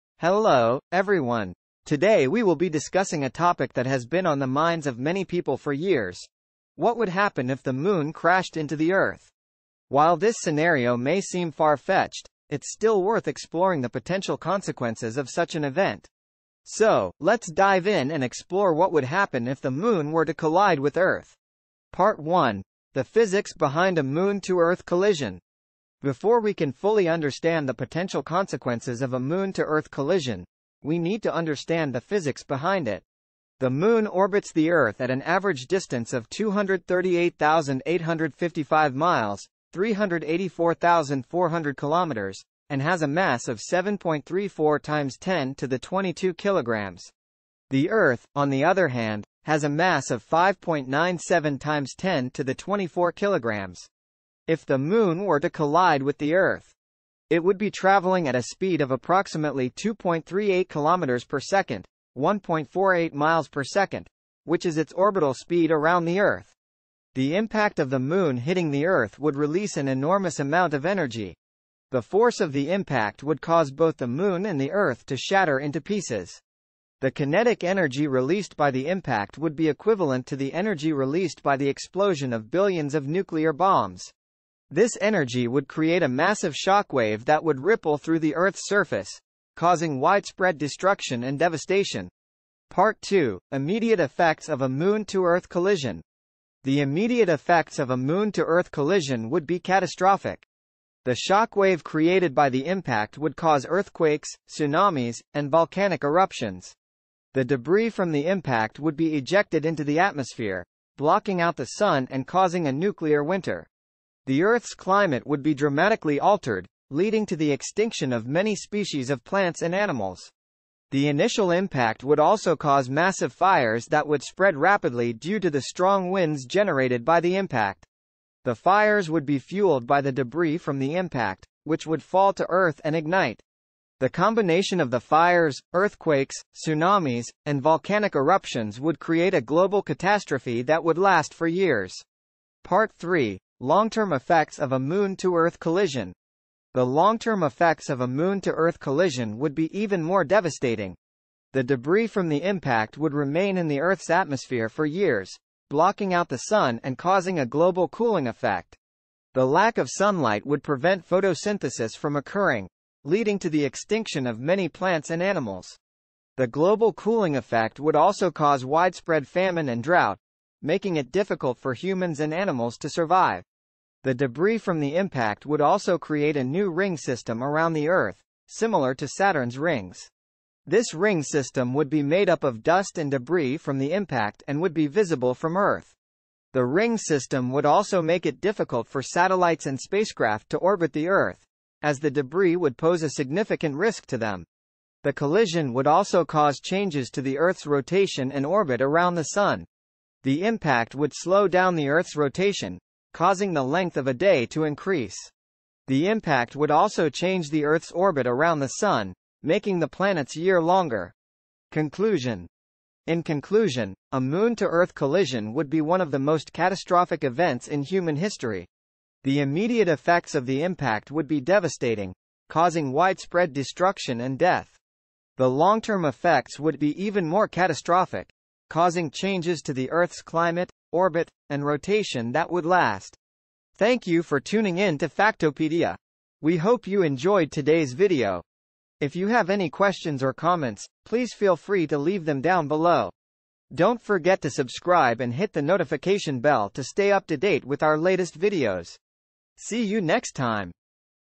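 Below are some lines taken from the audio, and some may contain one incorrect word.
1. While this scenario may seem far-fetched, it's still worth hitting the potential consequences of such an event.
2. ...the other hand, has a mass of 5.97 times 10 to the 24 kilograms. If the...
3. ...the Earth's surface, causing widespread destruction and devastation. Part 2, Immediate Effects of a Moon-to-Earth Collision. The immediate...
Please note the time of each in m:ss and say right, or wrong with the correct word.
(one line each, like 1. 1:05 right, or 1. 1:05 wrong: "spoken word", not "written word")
1. 0:09 wrong: "exploring", not "hitting"
2. 0:48 right
3. 1:28 right.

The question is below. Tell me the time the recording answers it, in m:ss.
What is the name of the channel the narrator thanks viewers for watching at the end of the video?
3:55.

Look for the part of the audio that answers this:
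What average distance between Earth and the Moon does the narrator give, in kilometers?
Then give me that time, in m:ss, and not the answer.
0:39.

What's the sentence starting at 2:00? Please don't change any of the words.
The initial impact would also cause massive fires that would spread rapidly due to the strong winds generated by the impact.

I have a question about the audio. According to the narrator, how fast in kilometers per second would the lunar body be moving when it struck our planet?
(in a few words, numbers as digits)
2.38 kilometers per second.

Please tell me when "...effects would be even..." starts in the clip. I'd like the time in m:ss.
3:46.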